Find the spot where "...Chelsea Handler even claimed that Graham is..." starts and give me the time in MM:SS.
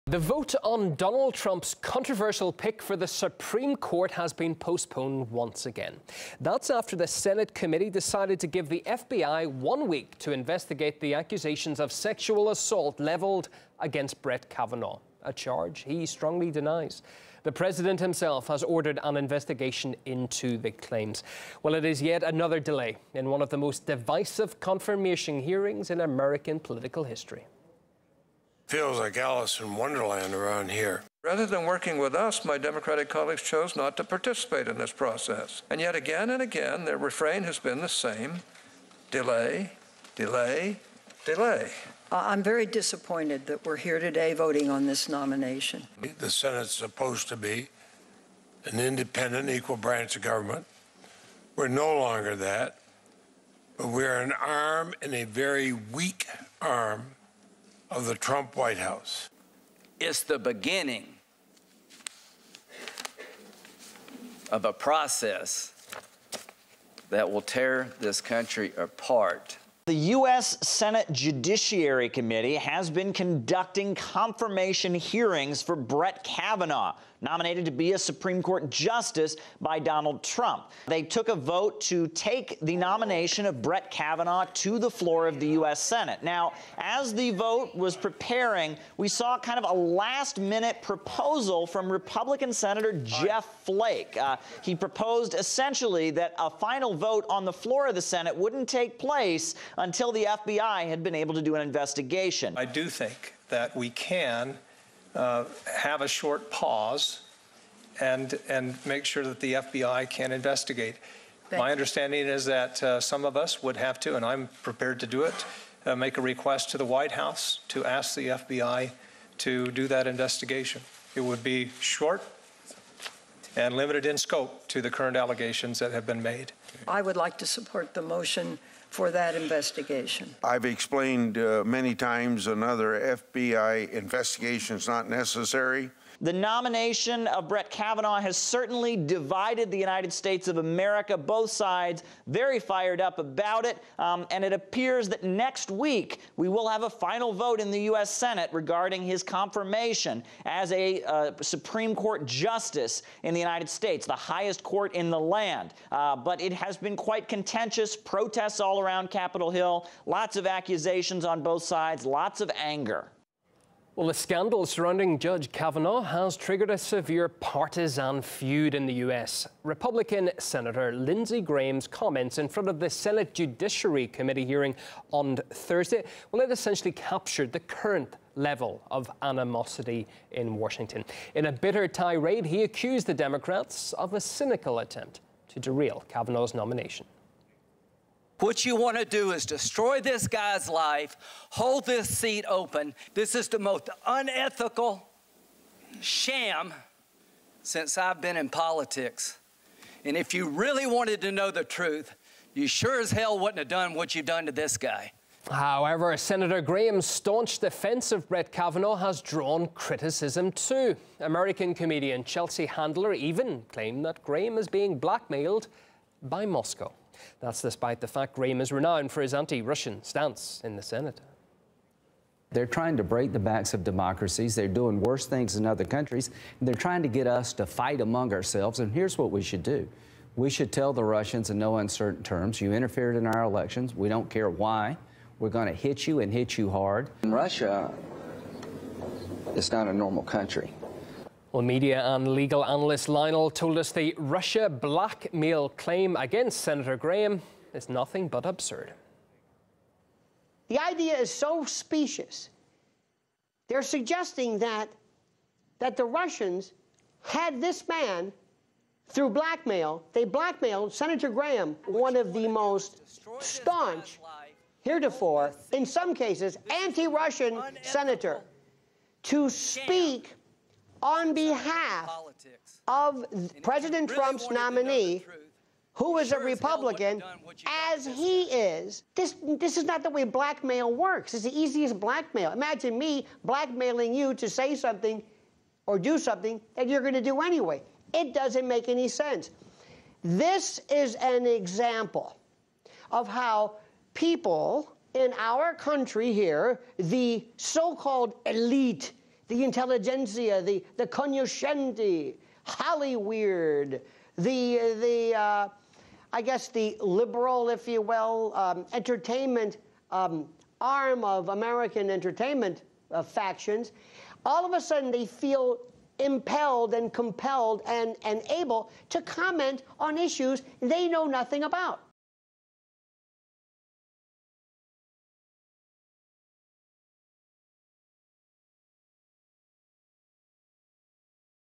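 03:32.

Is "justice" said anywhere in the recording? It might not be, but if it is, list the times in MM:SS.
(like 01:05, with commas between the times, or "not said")
01:18, 02:32.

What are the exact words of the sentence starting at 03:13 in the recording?
This is the most unethical sham since I've been in politics.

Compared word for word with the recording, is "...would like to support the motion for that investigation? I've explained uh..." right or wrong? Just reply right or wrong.
right.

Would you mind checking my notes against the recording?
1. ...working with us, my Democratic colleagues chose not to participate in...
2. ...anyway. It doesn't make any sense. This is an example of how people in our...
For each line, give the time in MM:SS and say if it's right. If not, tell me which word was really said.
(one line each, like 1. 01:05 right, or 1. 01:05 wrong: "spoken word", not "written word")
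1. 00:31 right
2. 04:47 right.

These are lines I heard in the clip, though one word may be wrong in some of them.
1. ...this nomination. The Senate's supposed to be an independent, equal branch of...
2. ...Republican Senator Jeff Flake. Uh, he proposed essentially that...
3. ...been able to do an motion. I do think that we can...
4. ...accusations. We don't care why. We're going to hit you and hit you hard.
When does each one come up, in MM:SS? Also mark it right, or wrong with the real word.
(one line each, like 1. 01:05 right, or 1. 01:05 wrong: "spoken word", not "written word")
1. 00:44 right
2. 01:31 right
3. 01:41 wrong: "investigation", not "motion"
4. 03:53 wrong: "elections", not "accusations".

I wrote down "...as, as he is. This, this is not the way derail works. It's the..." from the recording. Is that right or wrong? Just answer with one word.
wrong.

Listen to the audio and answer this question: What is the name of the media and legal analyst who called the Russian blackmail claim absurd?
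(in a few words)
Lionel.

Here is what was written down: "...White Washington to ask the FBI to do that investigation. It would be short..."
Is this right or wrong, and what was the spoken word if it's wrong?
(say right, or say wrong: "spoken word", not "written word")
wrong: "House", not "Washington".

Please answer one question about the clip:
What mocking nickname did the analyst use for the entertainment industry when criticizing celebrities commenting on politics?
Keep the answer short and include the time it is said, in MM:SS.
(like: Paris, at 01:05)
Hollyweird, at 05:02.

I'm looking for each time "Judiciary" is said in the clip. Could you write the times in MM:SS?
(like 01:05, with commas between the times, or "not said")
01:11, 02:53.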